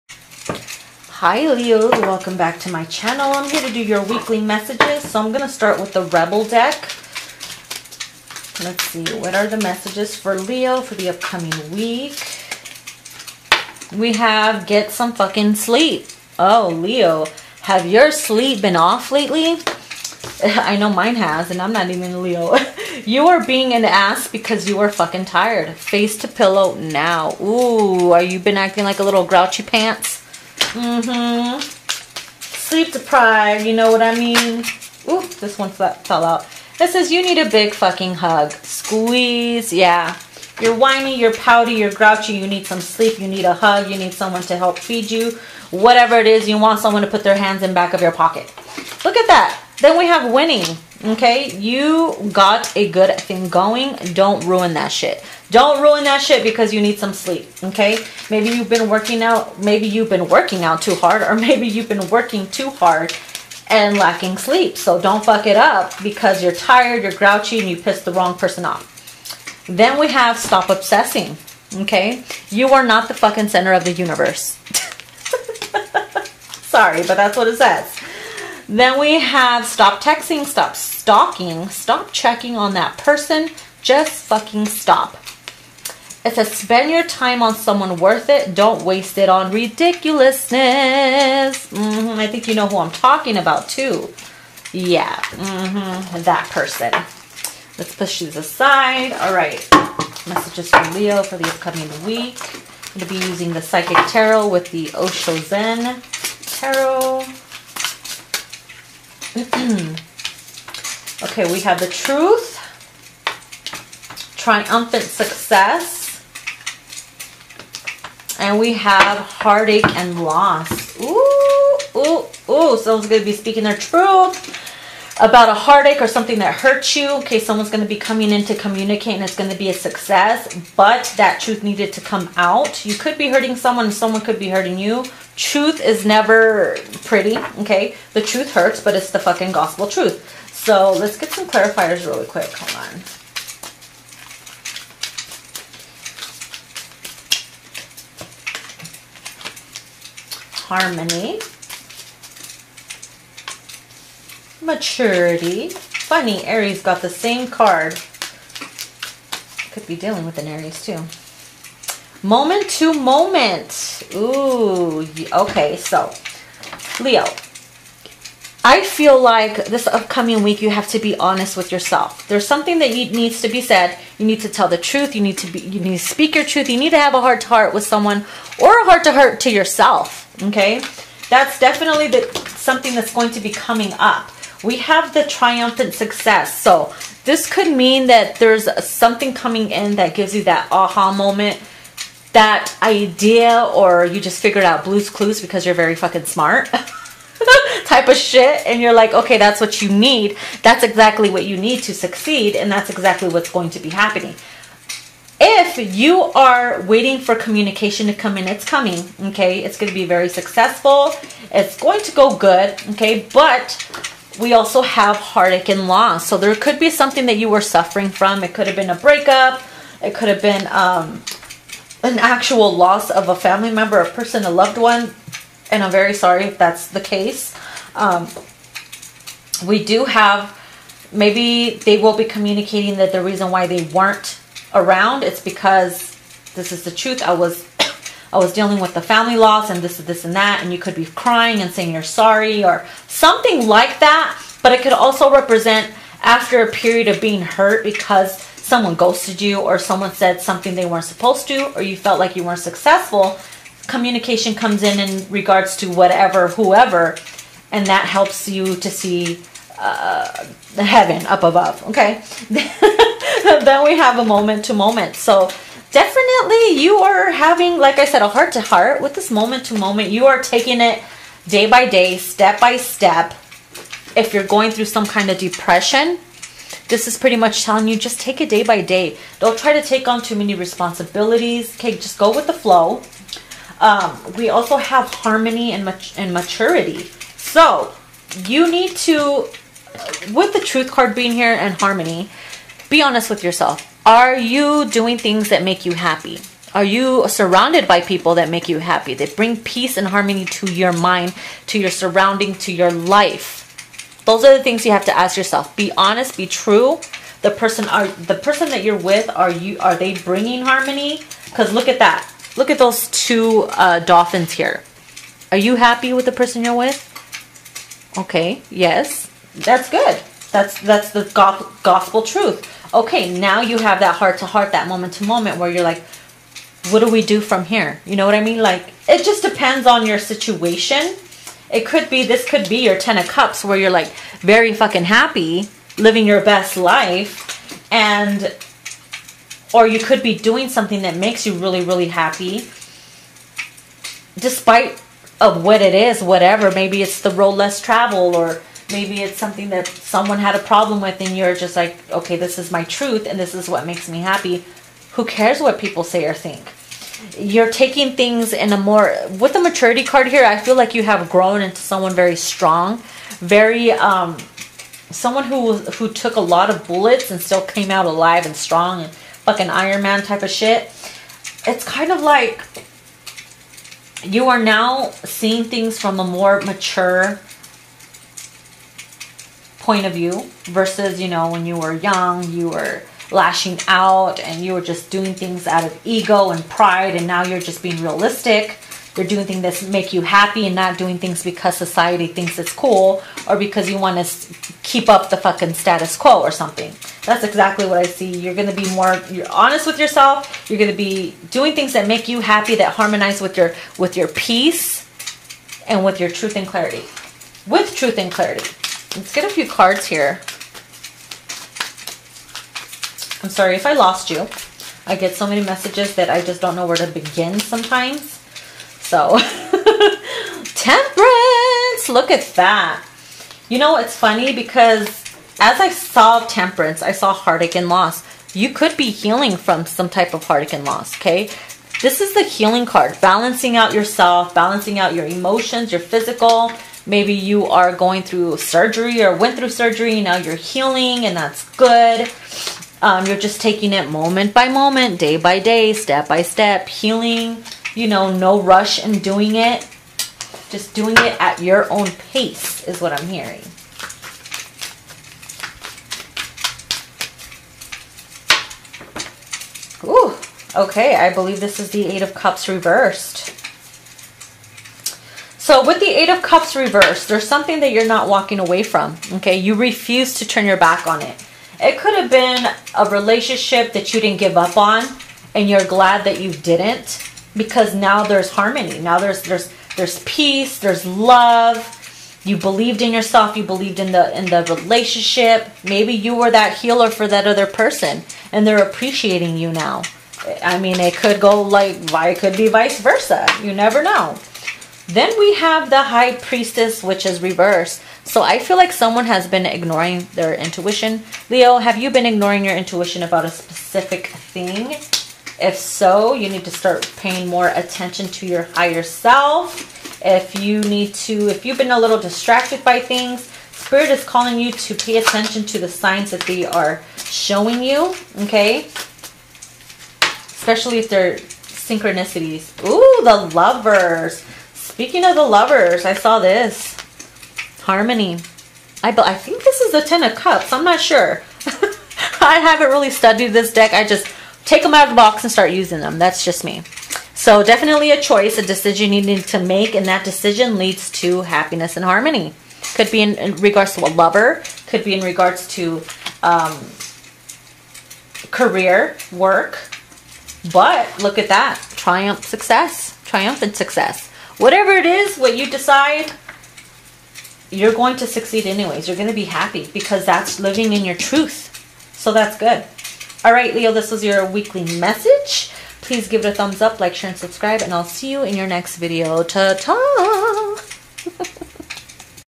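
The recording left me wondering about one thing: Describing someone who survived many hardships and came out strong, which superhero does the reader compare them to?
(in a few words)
Iron Man.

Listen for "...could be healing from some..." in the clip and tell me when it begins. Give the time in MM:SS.
07:08.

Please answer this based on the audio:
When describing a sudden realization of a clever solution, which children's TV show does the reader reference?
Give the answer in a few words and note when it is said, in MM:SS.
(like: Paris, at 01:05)
Blues Clues, at 03:14.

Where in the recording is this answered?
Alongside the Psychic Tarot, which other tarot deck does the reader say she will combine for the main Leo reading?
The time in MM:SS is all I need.
01:44.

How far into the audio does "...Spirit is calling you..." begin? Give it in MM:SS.
08:33.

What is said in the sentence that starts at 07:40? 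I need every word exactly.
Ooh, okay, I believe this is the Eight of Cups reversed.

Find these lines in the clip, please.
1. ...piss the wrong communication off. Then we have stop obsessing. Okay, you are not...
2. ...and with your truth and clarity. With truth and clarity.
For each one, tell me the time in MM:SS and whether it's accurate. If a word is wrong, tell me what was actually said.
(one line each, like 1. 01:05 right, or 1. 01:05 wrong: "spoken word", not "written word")
1. 01:07 wrong: "person", not "communication"
2. 06:45 right.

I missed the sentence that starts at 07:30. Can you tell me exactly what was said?
Just doing it at your own pace is what I'm hearing.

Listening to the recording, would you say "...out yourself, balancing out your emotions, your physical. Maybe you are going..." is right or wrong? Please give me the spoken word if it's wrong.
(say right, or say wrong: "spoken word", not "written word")
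right.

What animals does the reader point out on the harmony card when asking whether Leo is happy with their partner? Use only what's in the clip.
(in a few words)
Dolphins.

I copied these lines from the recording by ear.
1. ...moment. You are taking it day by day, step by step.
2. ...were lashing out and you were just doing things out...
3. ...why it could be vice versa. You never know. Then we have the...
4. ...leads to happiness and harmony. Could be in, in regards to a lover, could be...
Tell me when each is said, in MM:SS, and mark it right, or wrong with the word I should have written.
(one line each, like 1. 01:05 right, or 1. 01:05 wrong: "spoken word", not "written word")
1. 04:29 right
2. 06:22 right
3. 08:12 right
4. 09:00 right.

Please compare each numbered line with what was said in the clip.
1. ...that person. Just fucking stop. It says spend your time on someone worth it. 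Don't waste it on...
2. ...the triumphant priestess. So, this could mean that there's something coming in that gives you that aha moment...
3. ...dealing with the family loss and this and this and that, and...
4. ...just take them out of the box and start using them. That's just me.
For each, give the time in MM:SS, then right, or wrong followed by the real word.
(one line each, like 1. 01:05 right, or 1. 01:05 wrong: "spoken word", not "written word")
1. 01:22 right
2. 03:05 wrong: "success", not "priestess"
3. 03:58 right
4. 08:54 right.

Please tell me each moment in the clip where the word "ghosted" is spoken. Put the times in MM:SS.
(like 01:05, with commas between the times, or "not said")
04:08.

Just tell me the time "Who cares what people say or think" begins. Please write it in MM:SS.
05:55.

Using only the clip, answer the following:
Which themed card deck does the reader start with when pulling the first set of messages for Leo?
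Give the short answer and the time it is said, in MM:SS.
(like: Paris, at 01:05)
Rebel deck, at 00:06.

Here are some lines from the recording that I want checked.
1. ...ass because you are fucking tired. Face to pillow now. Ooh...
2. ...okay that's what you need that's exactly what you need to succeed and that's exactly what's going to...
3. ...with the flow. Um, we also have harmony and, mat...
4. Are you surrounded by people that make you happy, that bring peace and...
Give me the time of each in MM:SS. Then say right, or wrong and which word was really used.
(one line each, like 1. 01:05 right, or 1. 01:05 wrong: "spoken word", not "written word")
1. 00:23 right
2. 03:19 right
3. 04:42 right
4. 04:56 right.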